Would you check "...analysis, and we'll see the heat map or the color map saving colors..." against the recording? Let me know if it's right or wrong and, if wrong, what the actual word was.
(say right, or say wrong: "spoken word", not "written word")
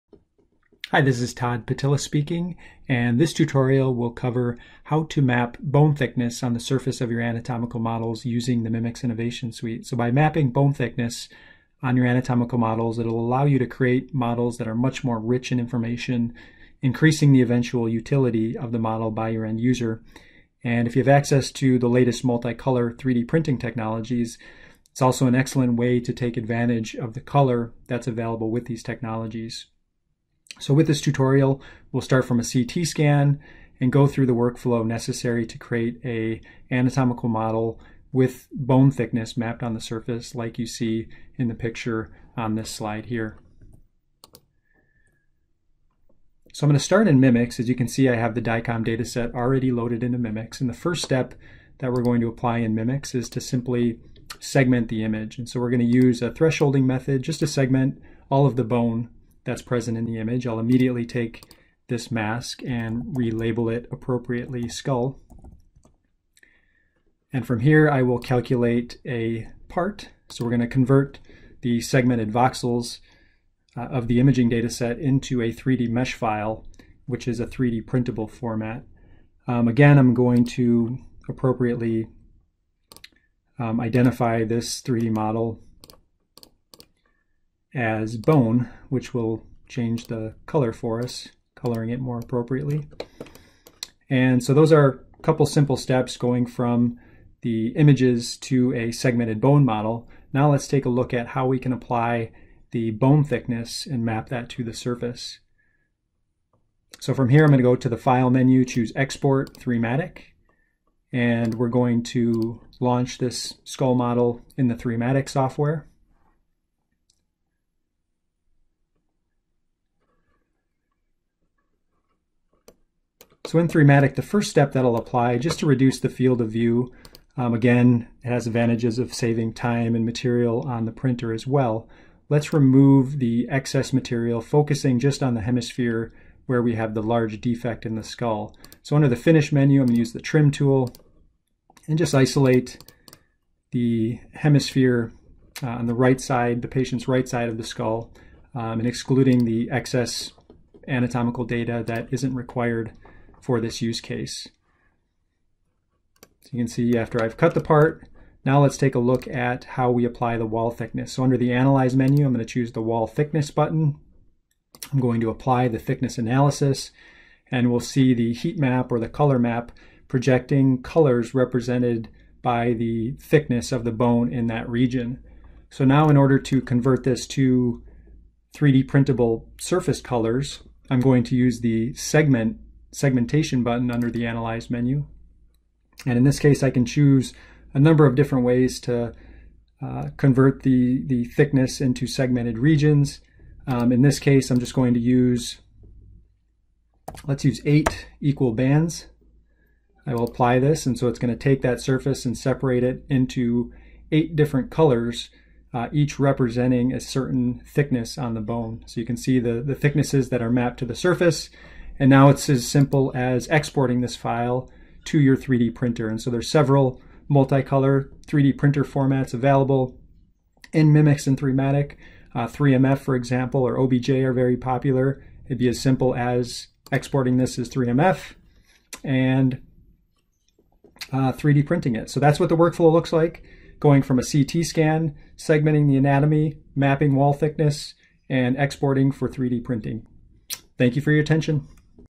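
wrong: "projecting", not "saving".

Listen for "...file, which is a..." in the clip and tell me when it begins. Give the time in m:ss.
1:16.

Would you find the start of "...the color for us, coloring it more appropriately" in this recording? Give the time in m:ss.
1:30.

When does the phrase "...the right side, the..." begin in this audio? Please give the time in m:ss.
2:25.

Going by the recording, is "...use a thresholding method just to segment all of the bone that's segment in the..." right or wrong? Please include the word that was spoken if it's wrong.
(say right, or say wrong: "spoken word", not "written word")
wrong: "present", not "segment".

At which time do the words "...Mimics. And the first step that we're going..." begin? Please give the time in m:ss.
0:50.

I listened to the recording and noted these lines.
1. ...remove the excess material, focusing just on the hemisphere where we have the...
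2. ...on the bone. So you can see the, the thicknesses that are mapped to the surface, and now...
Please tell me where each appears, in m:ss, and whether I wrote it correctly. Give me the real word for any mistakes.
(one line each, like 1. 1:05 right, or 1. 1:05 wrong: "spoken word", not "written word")
1. 2:12 right
2. 3:28 right.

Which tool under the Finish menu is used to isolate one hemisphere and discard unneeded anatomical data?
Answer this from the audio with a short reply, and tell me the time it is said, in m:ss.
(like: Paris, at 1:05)
Trim tool, at 2:20.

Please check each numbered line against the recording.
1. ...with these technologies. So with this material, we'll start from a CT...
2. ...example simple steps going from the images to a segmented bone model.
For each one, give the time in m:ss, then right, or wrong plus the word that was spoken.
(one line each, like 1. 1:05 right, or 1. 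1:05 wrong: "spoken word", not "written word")
1. 0:28 wrong: "tutorial", not "material"
2. 1:35 wrong: "couple", not "example".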